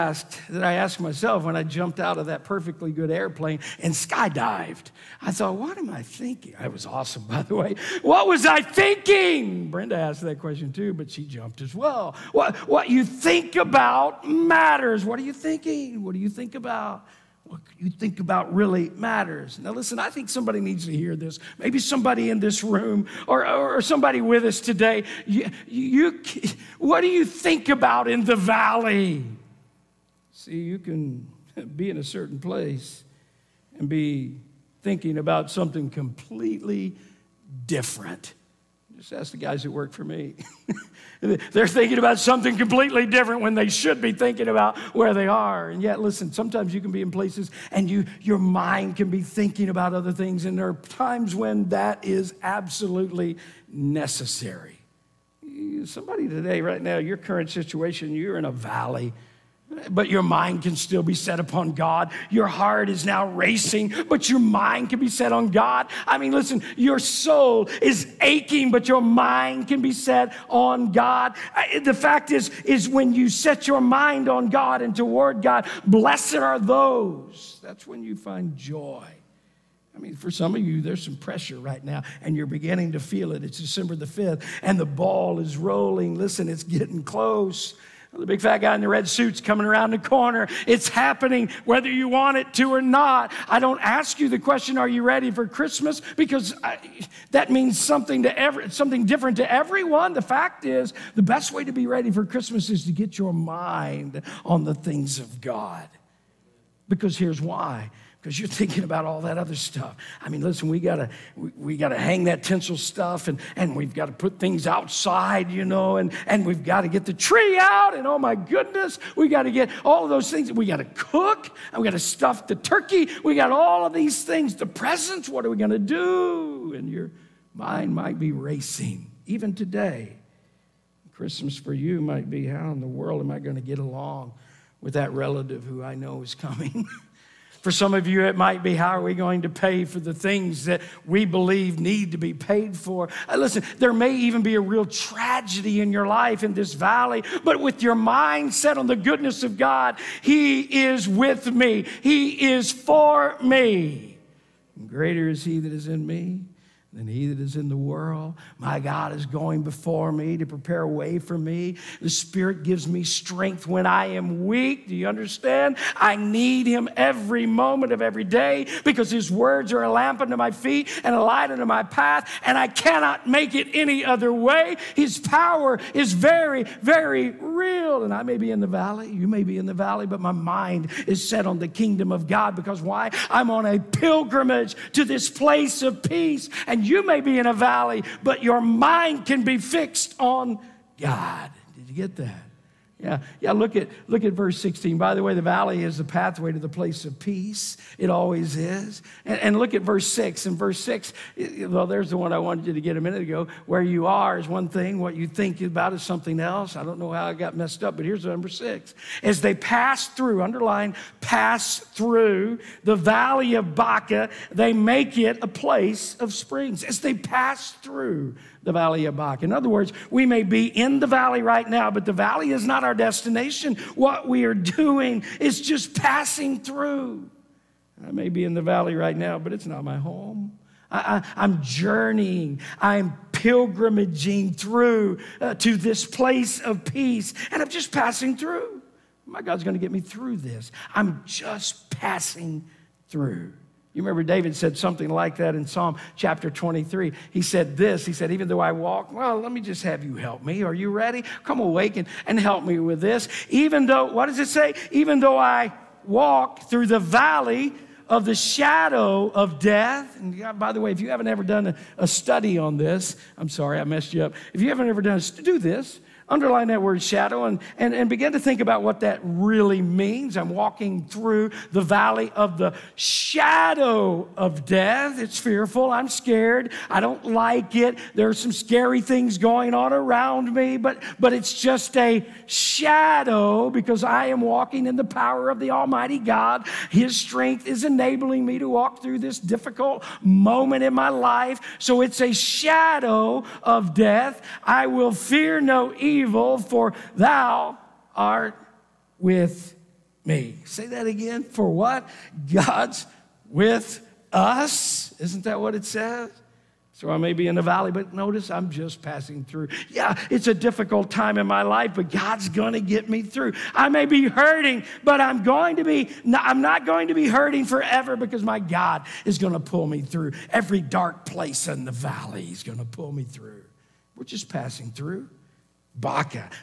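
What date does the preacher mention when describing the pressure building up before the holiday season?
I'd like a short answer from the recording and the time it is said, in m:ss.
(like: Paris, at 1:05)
December 5, at 1:23.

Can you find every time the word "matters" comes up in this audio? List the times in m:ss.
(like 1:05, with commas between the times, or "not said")
0:14, 0:18.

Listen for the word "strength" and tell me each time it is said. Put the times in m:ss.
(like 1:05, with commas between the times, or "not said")
2:43, 4:47.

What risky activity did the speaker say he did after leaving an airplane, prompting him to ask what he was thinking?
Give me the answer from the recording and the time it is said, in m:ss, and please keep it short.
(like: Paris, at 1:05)
Skydived, at 0:03.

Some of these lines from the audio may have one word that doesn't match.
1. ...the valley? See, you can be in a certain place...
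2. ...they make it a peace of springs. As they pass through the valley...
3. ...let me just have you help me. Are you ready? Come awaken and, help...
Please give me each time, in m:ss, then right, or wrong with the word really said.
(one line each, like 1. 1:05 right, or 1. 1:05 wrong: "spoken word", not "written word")
1. 0:28 right
2. 3:34 wrong: "place", not "peace"
3. 4:09 right.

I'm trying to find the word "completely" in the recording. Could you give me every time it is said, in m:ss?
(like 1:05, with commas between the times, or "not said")
0:35, 0:42.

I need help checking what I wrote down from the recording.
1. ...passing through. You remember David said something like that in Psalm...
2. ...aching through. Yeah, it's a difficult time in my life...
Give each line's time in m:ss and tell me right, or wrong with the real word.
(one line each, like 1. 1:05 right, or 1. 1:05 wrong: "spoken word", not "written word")
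1. 4:01 right
2. 5:09 wrong: "passing", not "aching".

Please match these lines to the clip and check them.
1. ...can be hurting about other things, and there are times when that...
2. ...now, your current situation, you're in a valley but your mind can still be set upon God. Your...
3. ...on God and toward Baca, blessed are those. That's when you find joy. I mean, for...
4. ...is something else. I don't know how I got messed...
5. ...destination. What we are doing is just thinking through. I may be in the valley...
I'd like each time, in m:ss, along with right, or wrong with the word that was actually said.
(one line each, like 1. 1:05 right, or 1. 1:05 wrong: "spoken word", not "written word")
1. 0:48 wrong: "thinking", not "hurting"
2. 0:56 right
3. 1:14 wrong: "God", not "Baca"
4. 3:25 right
5. 3:42 wrong: "passing", not "thinking".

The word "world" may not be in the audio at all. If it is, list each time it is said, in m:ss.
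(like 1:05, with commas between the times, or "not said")
2:12, 2:37.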